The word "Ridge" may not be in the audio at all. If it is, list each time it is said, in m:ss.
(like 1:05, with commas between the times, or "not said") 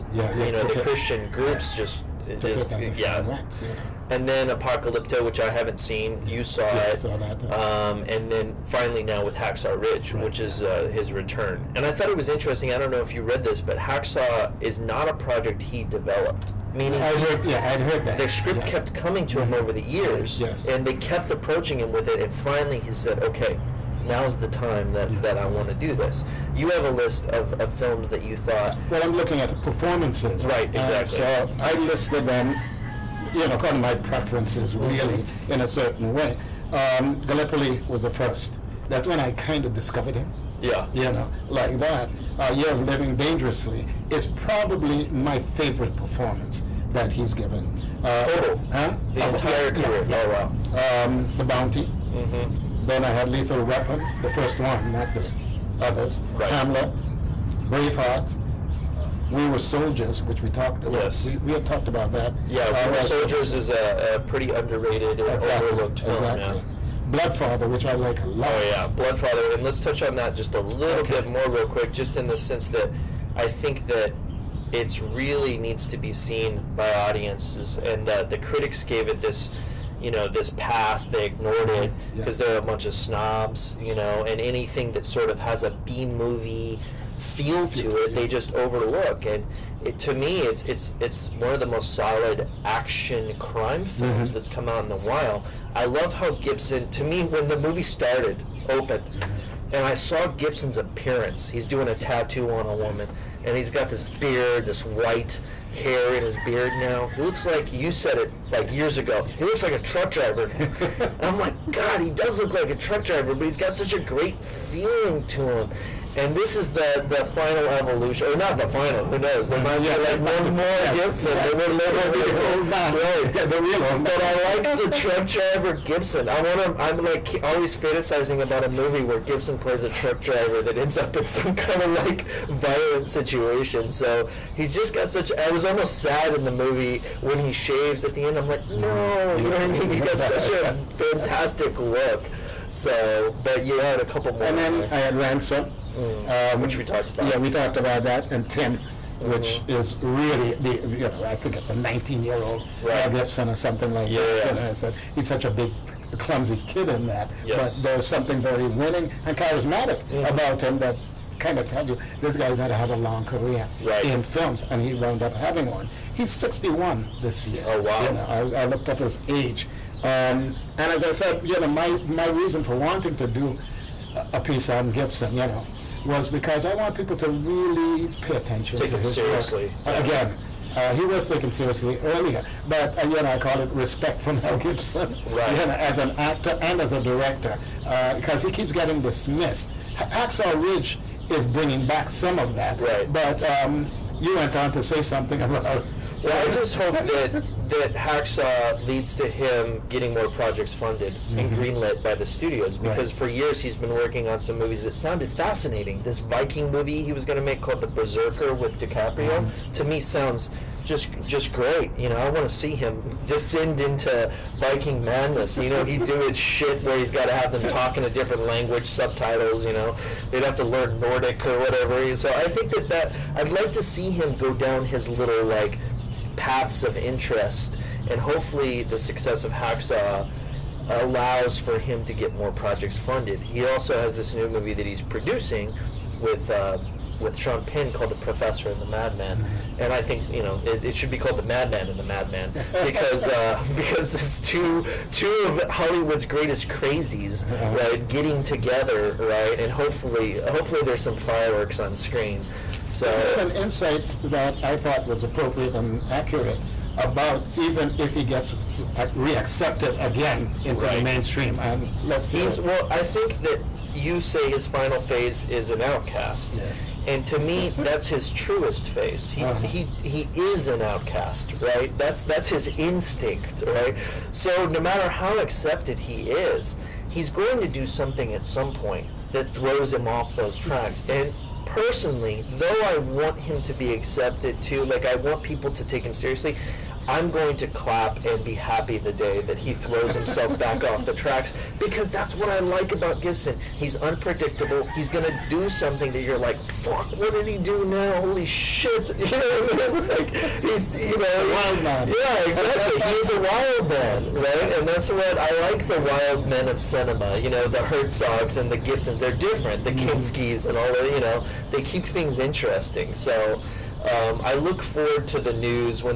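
0:09, 3:10.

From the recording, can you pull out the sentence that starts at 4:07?
right, getting together, right, and hopefully hopefully there's some fireworks on screen.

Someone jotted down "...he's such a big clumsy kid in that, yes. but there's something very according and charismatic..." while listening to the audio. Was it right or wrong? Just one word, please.
wrong.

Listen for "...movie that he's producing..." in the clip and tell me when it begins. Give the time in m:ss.
3:54.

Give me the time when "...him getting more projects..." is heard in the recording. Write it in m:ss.
3:19.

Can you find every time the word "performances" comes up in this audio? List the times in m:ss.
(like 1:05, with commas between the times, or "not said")
0:29, 0:45.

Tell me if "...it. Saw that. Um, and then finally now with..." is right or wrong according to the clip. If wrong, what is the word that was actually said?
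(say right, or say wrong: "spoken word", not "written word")
right.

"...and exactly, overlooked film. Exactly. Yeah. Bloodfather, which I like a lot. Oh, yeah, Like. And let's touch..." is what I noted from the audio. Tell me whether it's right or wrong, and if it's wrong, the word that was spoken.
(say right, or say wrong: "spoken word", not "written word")
wrong: "Bloodfather", not "Like".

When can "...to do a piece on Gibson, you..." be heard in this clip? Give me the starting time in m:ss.
2:53.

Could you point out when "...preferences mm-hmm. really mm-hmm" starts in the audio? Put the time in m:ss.
0:33.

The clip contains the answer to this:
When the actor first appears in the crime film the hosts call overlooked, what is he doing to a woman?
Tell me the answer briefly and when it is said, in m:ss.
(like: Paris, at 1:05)
A tattoo, at 1:41.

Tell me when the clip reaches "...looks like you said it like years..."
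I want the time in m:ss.
1:47.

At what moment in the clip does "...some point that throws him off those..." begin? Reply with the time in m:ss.
4:38.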